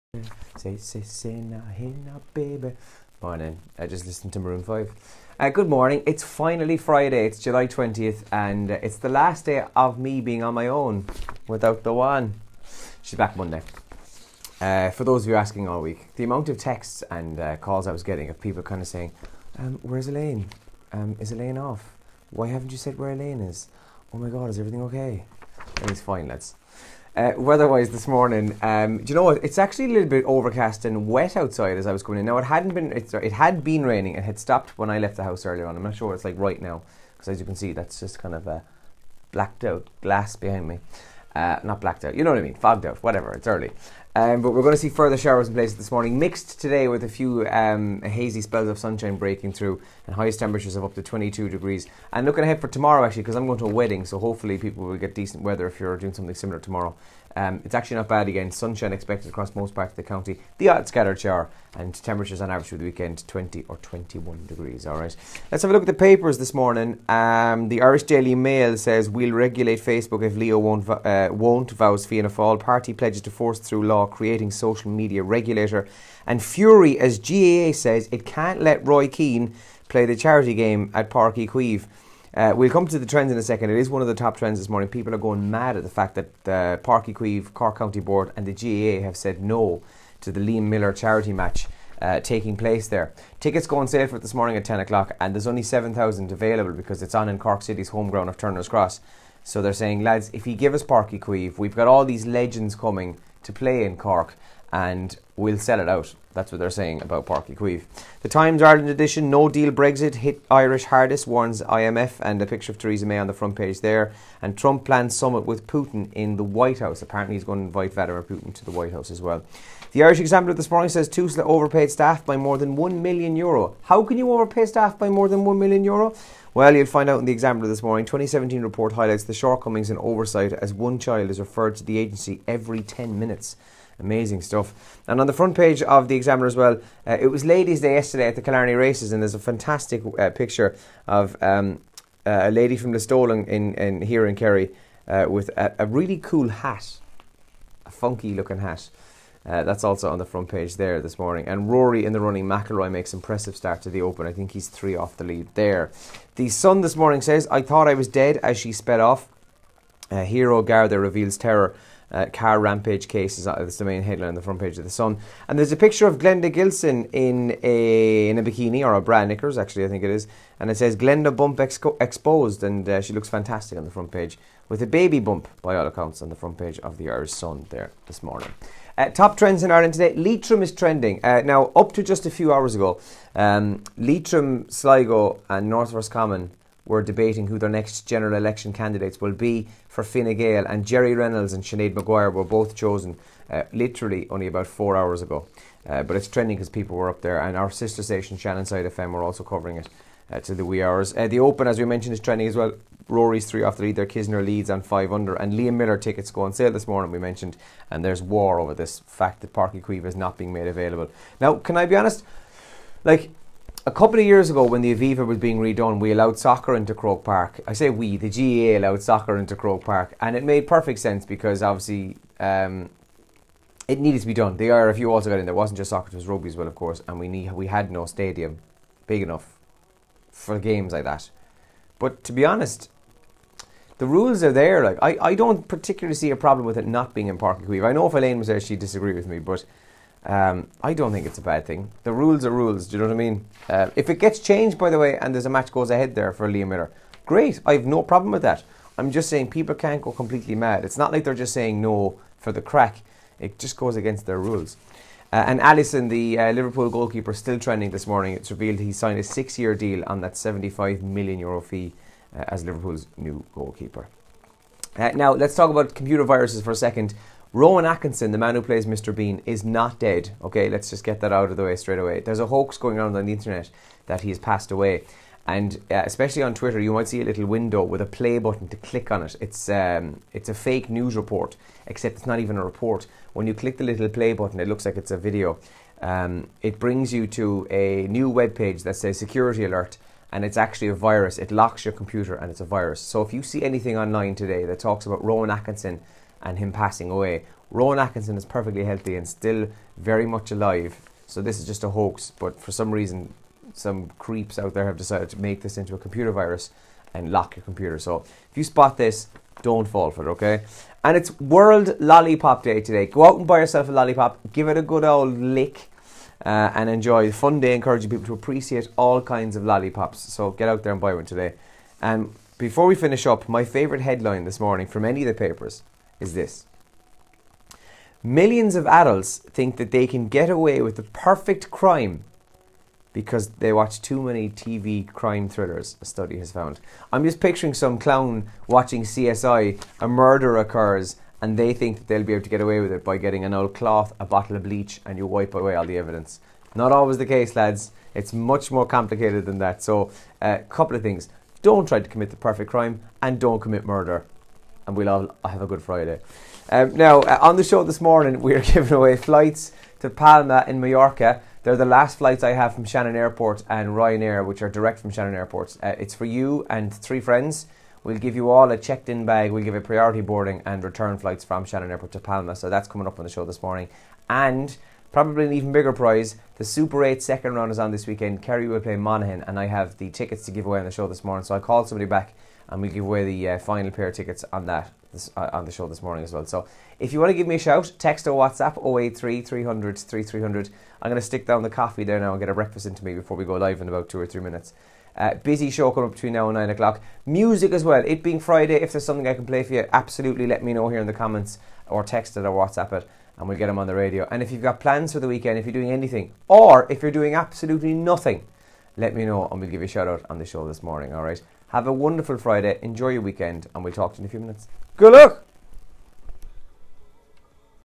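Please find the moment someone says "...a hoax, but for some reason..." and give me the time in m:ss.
5:01.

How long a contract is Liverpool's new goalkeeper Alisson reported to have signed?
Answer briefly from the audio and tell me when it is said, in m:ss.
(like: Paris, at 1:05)
six-year deal, at 4:19.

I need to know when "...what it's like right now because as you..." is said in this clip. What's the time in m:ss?
0:36.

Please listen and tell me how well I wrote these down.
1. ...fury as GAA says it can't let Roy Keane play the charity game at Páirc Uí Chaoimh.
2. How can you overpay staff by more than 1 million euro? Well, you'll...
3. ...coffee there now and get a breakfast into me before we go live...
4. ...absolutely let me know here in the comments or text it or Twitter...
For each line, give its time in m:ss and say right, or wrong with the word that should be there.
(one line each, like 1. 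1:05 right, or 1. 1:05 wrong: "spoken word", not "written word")
1. 1:16 right
2. 2:03 right
3. 6:31 right
4. 6:39 wrong: "WhatsApp", not "Twitter".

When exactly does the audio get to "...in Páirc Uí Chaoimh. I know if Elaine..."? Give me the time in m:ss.
3:57.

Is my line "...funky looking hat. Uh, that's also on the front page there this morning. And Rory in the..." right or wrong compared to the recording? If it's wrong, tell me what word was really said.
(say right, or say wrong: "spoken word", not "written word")
right.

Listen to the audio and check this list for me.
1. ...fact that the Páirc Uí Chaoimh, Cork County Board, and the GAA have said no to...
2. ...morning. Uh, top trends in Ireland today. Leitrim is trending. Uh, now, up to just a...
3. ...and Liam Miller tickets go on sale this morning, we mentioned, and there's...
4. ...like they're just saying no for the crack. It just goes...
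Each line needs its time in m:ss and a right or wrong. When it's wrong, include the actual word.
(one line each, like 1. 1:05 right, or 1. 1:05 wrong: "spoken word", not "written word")
1. 1:25 right
2. 2:58 right
3. 3:25 right
4. 4:11 right.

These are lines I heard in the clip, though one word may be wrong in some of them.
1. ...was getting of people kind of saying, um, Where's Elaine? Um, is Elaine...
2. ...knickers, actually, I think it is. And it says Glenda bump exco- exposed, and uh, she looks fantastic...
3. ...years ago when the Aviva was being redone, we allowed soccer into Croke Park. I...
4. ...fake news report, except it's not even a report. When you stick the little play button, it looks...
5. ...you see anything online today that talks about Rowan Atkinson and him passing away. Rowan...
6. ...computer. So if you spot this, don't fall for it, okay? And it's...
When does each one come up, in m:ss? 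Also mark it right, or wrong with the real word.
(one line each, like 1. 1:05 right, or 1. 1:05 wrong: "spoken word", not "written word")
1. 0:17 right
2. 2:49 right
3. 3:34 right
4. 4:40 wrong: "click", not "stick"
5. 4:53 right
6. 5:07 right.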